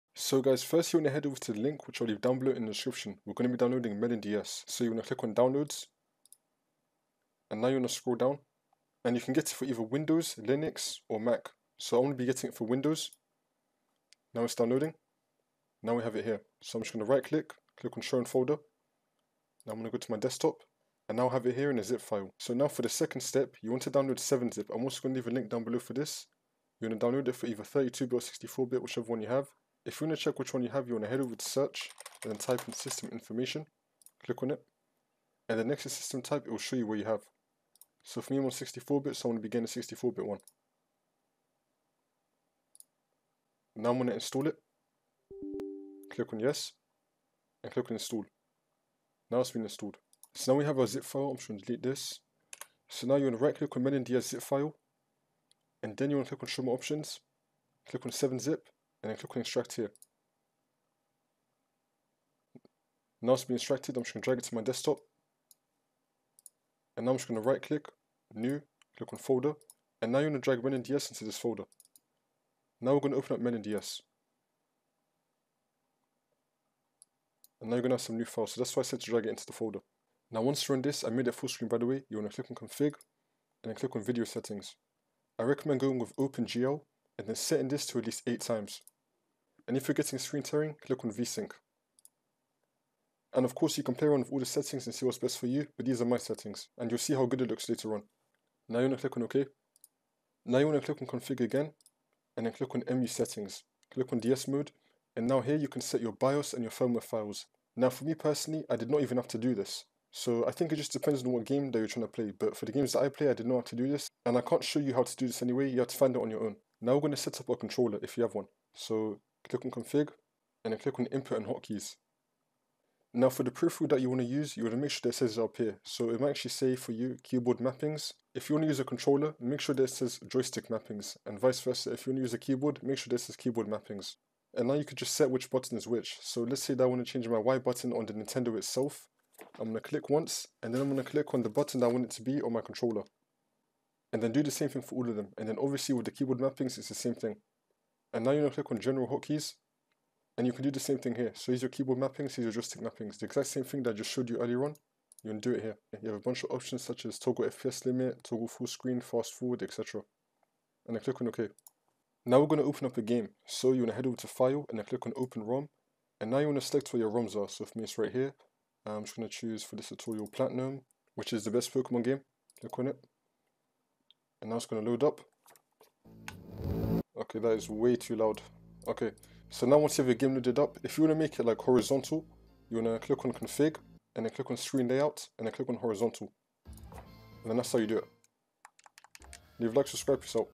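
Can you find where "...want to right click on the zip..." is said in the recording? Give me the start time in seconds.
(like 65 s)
53 s.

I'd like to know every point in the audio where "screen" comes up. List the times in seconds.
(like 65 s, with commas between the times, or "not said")
81 s, 90 s, 158 s, 184 s.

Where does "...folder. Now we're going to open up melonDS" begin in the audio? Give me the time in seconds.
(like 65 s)
71 s.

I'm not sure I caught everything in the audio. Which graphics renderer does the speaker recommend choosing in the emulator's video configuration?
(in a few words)
OpenGL.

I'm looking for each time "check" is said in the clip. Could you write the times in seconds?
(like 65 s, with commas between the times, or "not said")
30 s.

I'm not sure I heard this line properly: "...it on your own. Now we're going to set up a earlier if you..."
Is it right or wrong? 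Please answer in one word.
wrong.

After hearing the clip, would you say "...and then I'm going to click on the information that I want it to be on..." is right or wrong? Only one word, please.
wrong.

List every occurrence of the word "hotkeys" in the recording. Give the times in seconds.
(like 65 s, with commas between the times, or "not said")
121 s, 149 s.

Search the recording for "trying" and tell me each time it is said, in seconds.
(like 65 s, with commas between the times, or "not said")
111 s.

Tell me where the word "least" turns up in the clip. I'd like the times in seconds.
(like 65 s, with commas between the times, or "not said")
88 s.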